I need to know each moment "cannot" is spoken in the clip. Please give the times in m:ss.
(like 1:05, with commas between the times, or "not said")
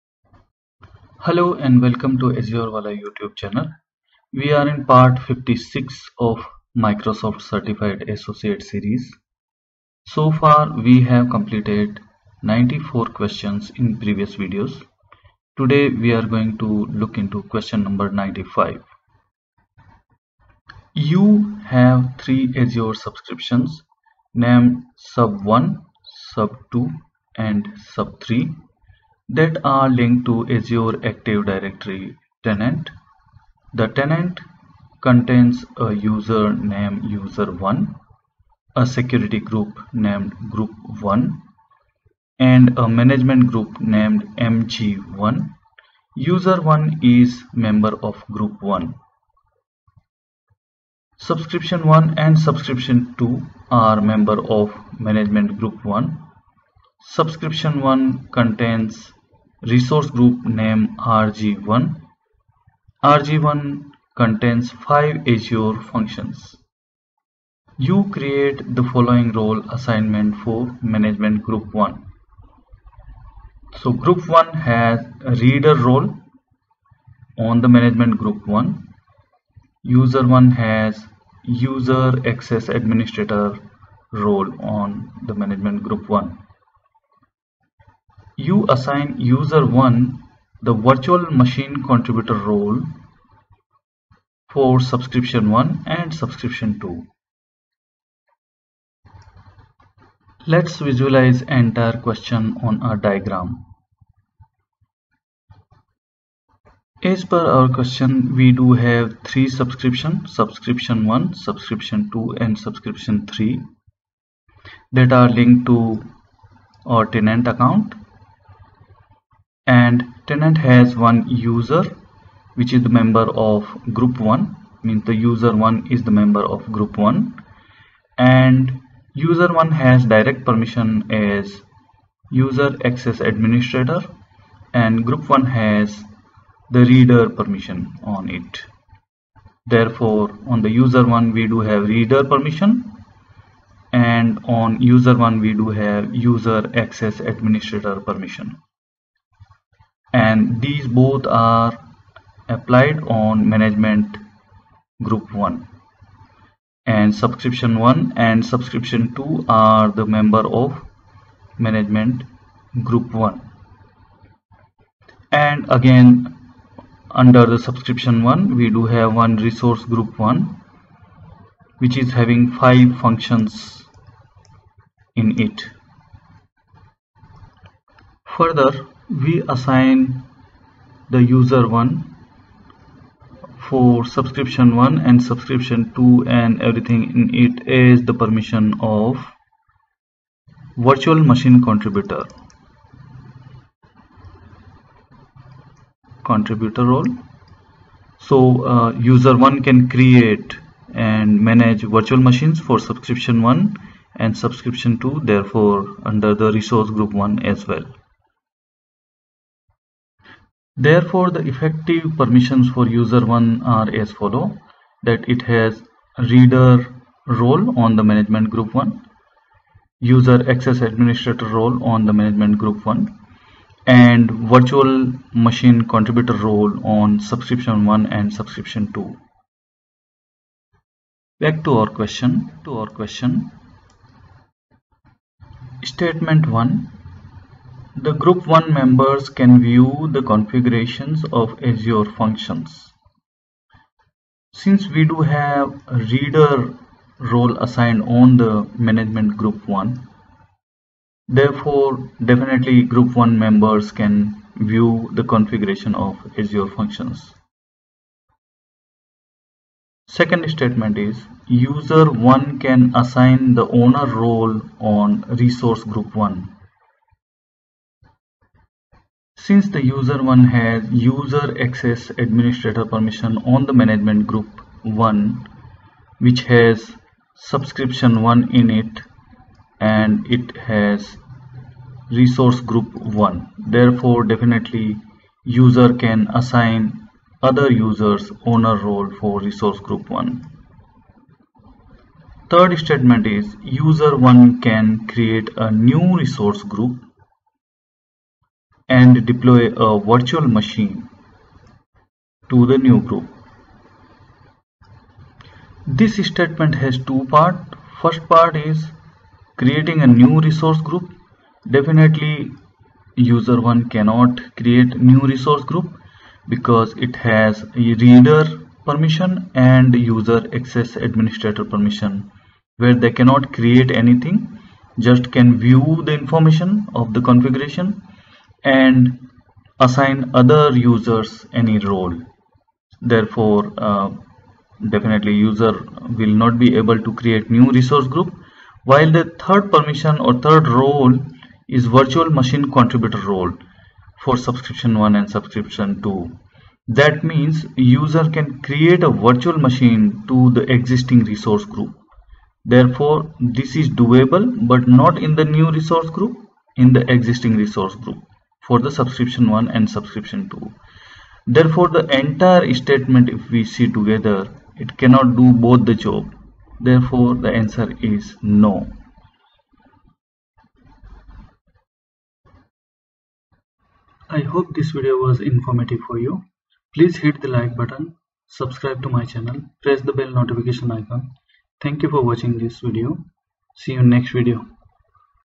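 5:13, 5:23, 6:05.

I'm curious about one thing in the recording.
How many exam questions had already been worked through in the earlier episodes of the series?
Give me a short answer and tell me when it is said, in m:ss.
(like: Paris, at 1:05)
94, at 0:12.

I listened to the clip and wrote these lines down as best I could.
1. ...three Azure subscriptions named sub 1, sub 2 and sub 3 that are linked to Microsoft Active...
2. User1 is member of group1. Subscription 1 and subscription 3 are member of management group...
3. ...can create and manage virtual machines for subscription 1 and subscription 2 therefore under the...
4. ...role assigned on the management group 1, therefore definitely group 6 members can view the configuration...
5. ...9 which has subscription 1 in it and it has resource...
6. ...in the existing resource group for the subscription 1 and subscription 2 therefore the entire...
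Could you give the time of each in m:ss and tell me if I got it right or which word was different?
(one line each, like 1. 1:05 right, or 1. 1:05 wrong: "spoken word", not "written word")
1. 0:22 wrong: "Azure", not "Microsoft"
2. 0:46 wrong: "2", not "3"
3. 3:19 right
4. 4:07 wrong: "1", not "6"
5. 4:34 wrong: "1", not "9"
6. 5:56 right.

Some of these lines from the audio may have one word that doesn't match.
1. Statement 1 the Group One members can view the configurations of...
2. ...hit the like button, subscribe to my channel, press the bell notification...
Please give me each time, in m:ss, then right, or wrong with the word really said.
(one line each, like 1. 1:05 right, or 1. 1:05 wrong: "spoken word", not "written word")
1. 3:55 right
2. 6:17 right.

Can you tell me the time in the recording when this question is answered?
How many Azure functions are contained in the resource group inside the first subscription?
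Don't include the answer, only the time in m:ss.
1:04.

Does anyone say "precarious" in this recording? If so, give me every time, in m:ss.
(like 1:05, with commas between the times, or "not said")
not said.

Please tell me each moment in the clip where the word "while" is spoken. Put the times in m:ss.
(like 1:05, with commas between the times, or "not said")
5:38.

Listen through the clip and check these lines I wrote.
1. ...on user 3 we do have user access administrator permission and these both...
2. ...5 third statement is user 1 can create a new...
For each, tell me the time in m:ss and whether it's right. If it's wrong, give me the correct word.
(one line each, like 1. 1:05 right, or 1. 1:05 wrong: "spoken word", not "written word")
1. 2:24 wrong: "1", not "3"
2. 4:50 wrong: "1", not "5".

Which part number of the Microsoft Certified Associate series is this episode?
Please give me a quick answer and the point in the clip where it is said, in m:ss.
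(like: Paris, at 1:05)
56, at 0:04.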